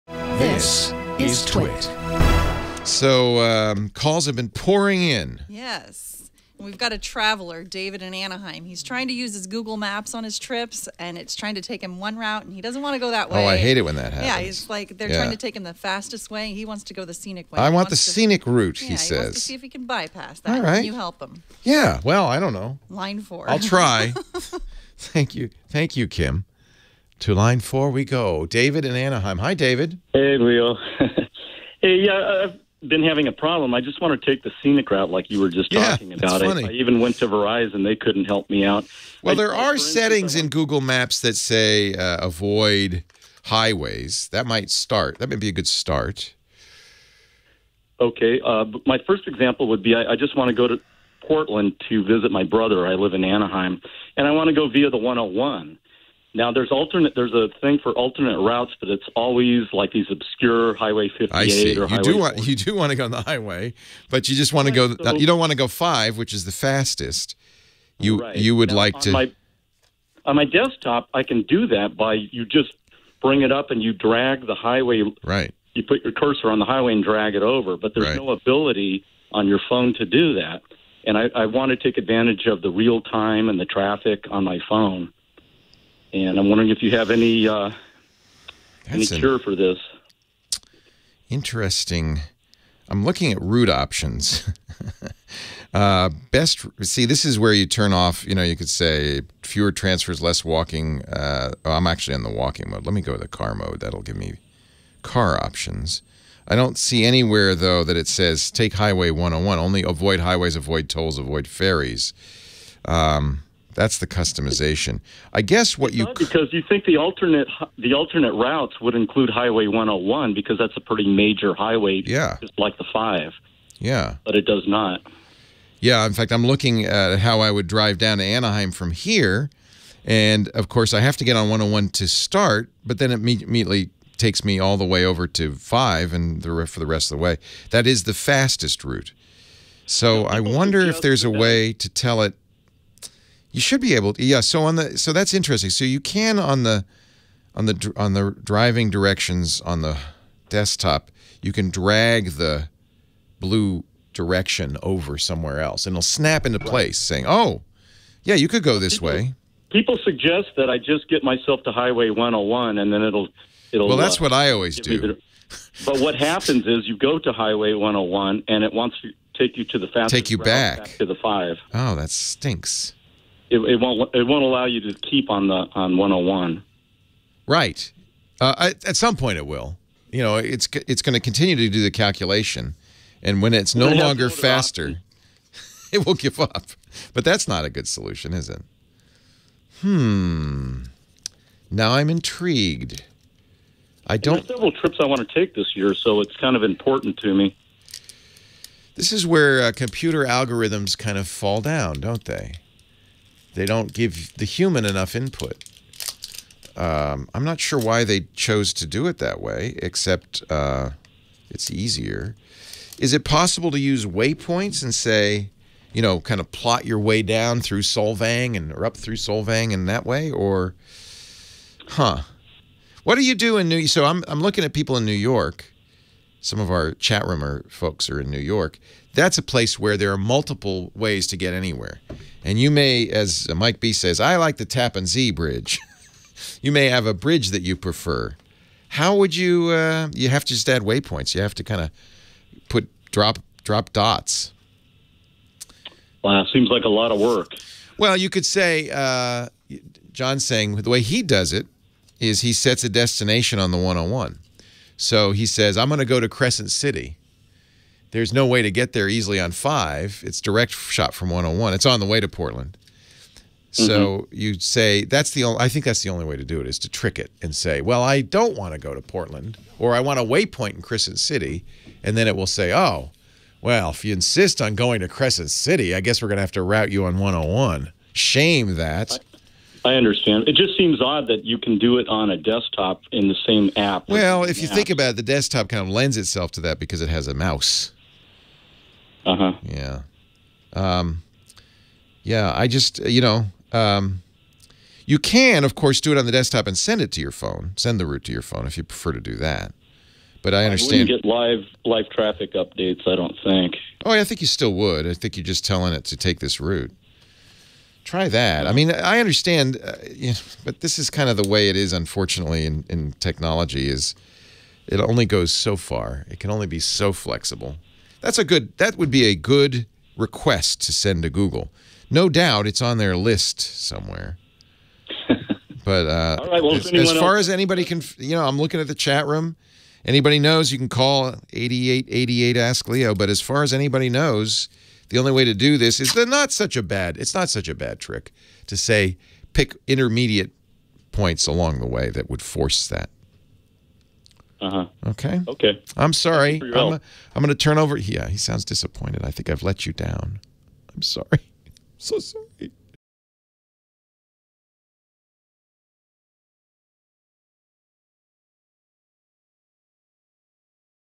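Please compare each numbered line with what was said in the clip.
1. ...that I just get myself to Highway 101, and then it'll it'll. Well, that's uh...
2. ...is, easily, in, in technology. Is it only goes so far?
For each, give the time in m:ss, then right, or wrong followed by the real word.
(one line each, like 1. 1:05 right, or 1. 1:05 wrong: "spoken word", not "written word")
1. 2:40 right
2. 5:11 wrong: "unfortunately", not "easily".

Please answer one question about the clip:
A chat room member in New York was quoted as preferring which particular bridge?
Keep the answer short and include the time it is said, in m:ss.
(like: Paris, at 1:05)
Tappan Zee Bridge, at 3:54.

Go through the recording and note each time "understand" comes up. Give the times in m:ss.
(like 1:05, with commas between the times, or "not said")
4:39, 5:00, 5:09.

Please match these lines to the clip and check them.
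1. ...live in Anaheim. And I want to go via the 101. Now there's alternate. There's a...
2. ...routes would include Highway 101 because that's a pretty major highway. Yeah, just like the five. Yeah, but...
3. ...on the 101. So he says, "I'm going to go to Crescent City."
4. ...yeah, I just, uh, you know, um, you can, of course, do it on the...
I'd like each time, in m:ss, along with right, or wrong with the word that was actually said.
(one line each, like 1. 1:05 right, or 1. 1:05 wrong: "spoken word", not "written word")
1. 0:52 right
2. 1:58 right
3. 4:13 right
4. 4:52 right.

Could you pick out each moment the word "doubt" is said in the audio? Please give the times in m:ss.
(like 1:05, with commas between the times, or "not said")
5:22.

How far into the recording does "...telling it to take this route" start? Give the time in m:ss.
5:05.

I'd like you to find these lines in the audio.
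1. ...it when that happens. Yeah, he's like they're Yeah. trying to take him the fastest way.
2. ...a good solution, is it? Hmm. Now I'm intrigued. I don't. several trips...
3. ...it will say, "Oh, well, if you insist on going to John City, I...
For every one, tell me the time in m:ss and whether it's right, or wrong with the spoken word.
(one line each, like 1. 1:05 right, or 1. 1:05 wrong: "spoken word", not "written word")
1. 0:13 right
2. 3:07 right
3. 4:32 wrong: "Crescent", not "John".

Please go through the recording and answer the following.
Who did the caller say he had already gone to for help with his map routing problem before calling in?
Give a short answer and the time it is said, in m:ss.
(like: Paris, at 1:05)
Verizon, at 0:37.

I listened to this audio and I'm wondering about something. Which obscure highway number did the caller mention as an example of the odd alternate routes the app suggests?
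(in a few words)
58.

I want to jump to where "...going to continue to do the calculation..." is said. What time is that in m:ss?
3:01.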